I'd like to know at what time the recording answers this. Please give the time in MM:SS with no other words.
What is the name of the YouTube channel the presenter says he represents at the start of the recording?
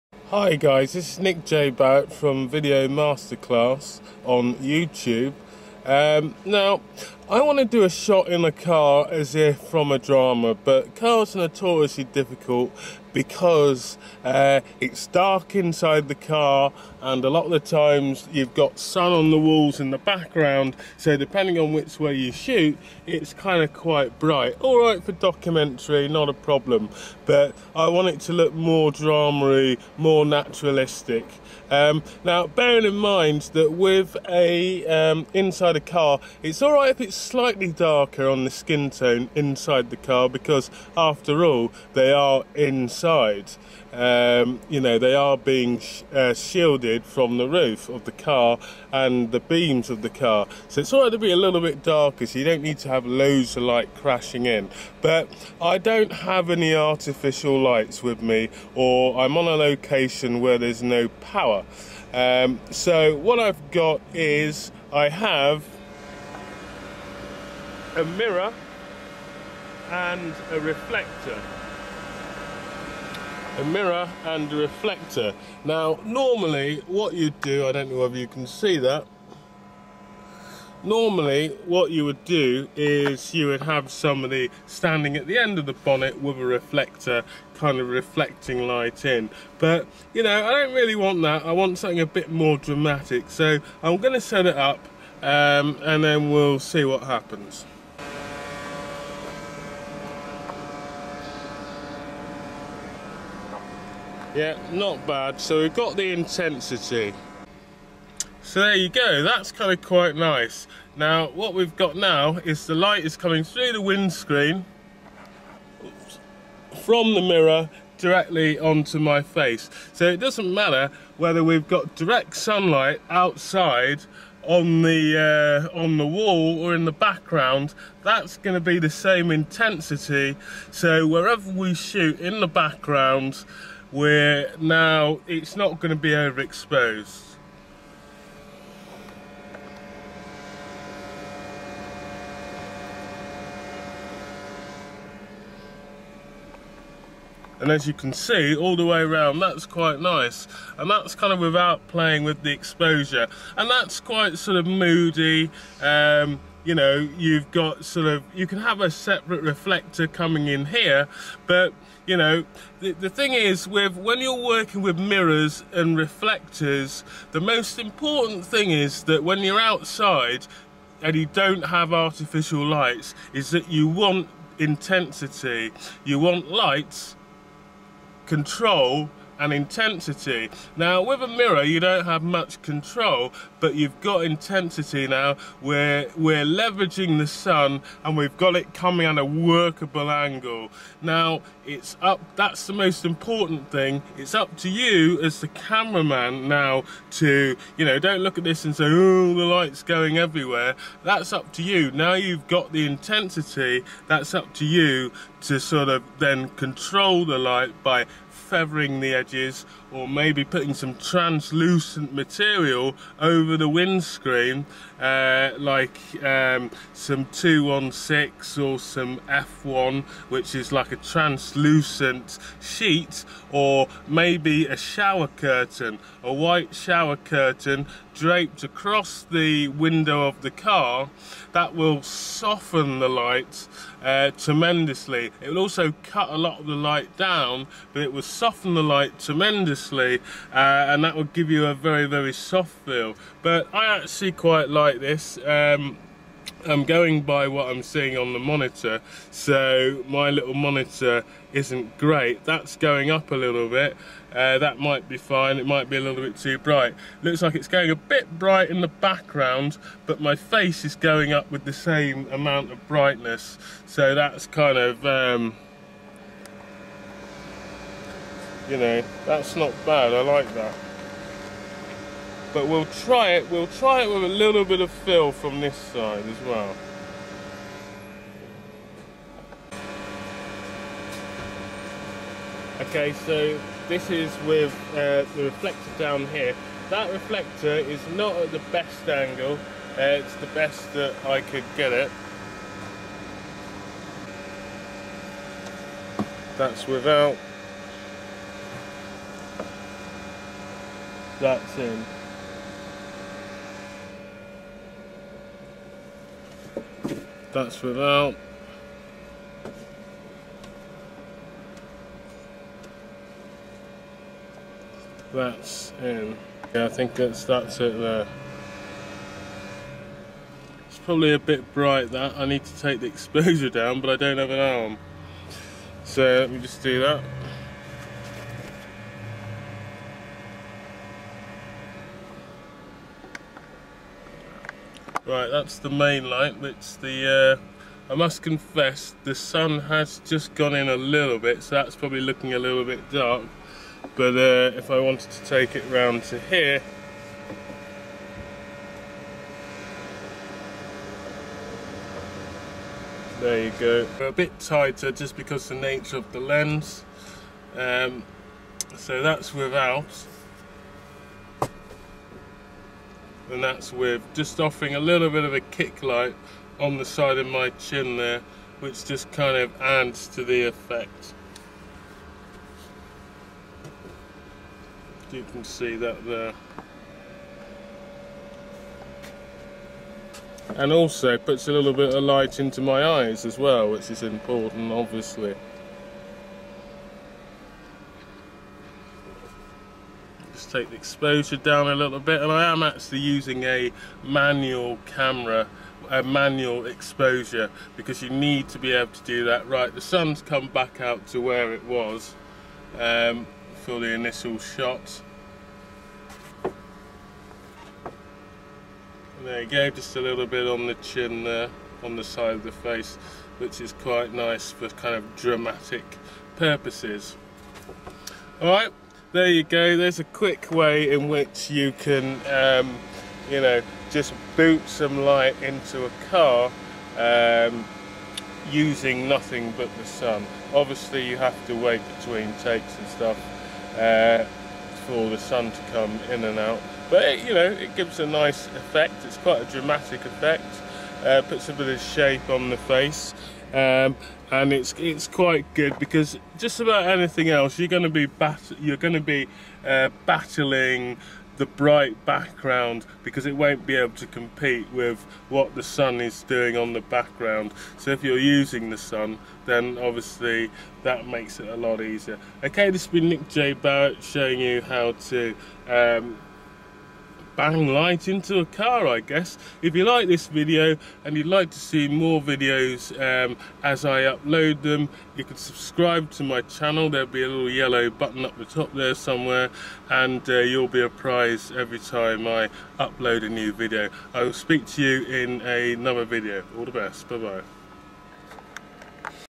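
00:02.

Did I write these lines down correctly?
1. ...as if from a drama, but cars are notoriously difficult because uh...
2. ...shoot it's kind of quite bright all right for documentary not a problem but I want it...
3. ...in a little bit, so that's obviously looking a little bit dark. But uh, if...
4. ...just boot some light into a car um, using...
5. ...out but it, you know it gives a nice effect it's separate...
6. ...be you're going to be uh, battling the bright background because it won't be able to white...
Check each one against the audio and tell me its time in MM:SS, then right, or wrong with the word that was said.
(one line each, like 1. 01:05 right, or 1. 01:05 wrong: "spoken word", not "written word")
1. 00:09 right
2. 00:22 right
3. 05:40 wrong: "probably", not "obviously"
4. 07:04 right
5. 07:16 wrong: "quite", not "separate"
6. 07:28 wrong: "compete", not "white".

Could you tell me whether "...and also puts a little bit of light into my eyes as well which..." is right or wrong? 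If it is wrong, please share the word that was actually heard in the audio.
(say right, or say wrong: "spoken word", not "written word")
right.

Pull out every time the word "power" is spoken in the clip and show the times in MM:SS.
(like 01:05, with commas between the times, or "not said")
01:01.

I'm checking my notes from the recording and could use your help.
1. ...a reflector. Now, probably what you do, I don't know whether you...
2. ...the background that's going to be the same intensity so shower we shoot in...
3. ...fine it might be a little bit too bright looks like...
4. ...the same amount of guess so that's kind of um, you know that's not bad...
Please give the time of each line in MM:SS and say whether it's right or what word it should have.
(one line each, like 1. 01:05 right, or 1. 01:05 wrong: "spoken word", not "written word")
1. 01:14 wrong: "normally", not "probably"
2. 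02:06 wrong: "wherever", not "shower"
3. 04:15 right
4. 04:21 wrong: "brightness", not "guess".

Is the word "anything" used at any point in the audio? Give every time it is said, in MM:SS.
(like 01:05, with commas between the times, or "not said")
07:27.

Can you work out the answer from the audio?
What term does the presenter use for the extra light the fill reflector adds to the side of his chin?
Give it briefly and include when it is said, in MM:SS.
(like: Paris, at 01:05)
Kick light, at 06:05.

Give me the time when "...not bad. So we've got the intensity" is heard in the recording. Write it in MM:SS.
01:44.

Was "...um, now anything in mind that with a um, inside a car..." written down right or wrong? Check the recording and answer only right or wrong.
wrong.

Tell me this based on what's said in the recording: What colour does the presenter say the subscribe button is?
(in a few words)
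Yellow.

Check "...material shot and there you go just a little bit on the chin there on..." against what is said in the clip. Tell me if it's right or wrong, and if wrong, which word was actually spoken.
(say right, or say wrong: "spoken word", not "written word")
wrong: "initial", not "material".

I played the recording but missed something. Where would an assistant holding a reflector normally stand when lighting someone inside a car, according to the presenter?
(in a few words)
End of the bonnet.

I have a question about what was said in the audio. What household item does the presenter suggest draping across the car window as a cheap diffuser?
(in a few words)
White shower curtain.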